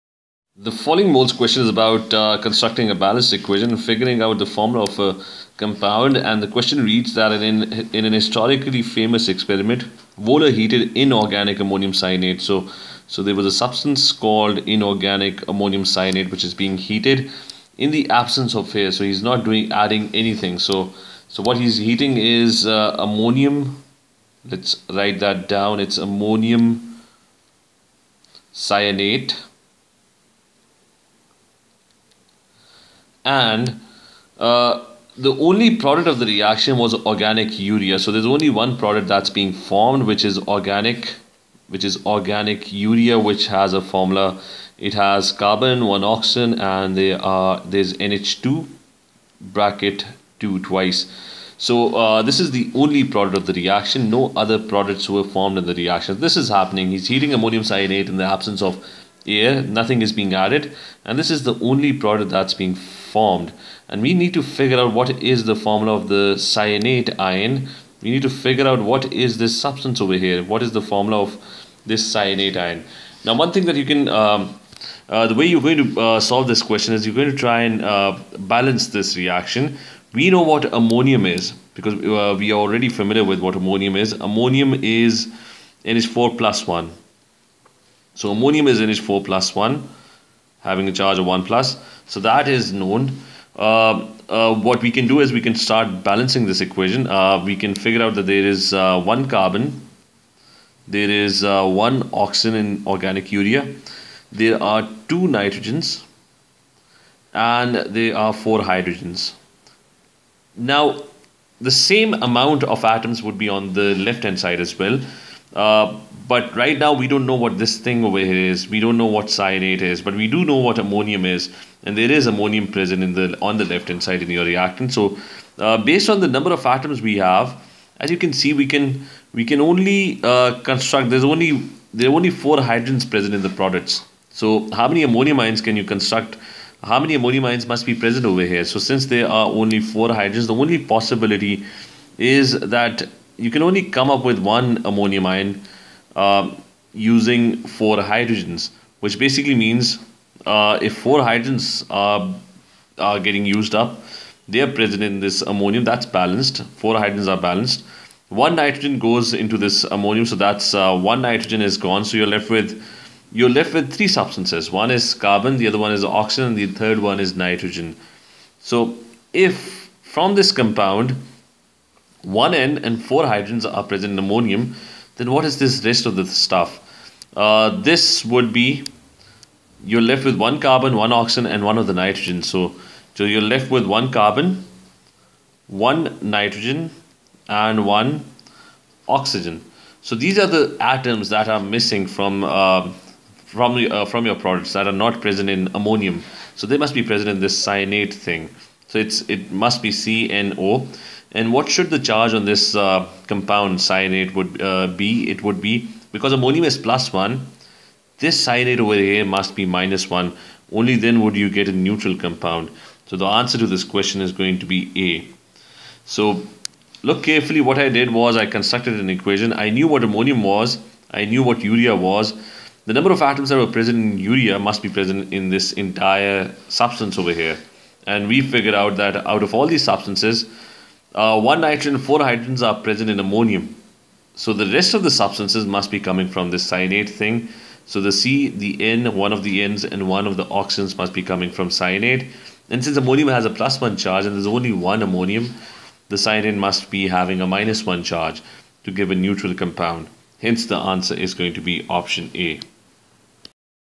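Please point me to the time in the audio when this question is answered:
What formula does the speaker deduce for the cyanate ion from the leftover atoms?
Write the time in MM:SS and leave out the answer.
03:19.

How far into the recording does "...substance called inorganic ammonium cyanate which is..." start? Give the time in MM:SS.
00:13.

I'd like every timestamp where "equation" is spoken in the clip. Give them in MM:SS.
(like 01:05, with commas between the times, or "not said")
00:03, 01:36, 03:39.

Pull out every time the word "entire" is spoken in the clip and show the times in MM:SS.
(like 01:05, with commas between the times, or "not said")
03:45.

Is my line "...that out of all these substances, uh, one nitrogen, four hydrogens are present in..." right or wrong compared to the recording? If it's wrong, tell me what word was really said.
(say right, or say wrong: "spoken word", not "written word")
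right.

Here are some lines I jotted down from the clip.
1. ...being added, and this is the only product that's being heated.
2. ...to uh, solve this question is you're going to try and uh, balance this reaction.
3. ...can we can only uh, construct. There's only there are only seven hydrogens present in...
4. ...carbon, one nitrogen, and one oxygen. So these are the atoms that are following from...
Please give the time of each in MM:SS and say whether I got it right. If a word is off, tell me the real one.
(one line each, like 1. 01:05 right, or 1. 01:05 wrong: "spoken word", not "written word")
1. 01:00 wrong: "formed", not "heated"
2. 01:15 right
3. 02:08 wrong: "four", not "seven"
4. 03:04 wrong: "missing", not "following".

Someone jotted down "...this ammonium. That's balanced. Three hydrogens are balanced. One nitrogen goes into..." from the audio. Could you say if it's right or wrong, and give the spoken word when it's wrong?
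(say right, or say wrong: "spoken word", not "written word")
wrong: "Four", not "Three".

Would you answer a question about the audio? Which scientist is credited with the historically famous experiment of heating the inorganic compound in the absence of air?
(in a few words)
Wohler.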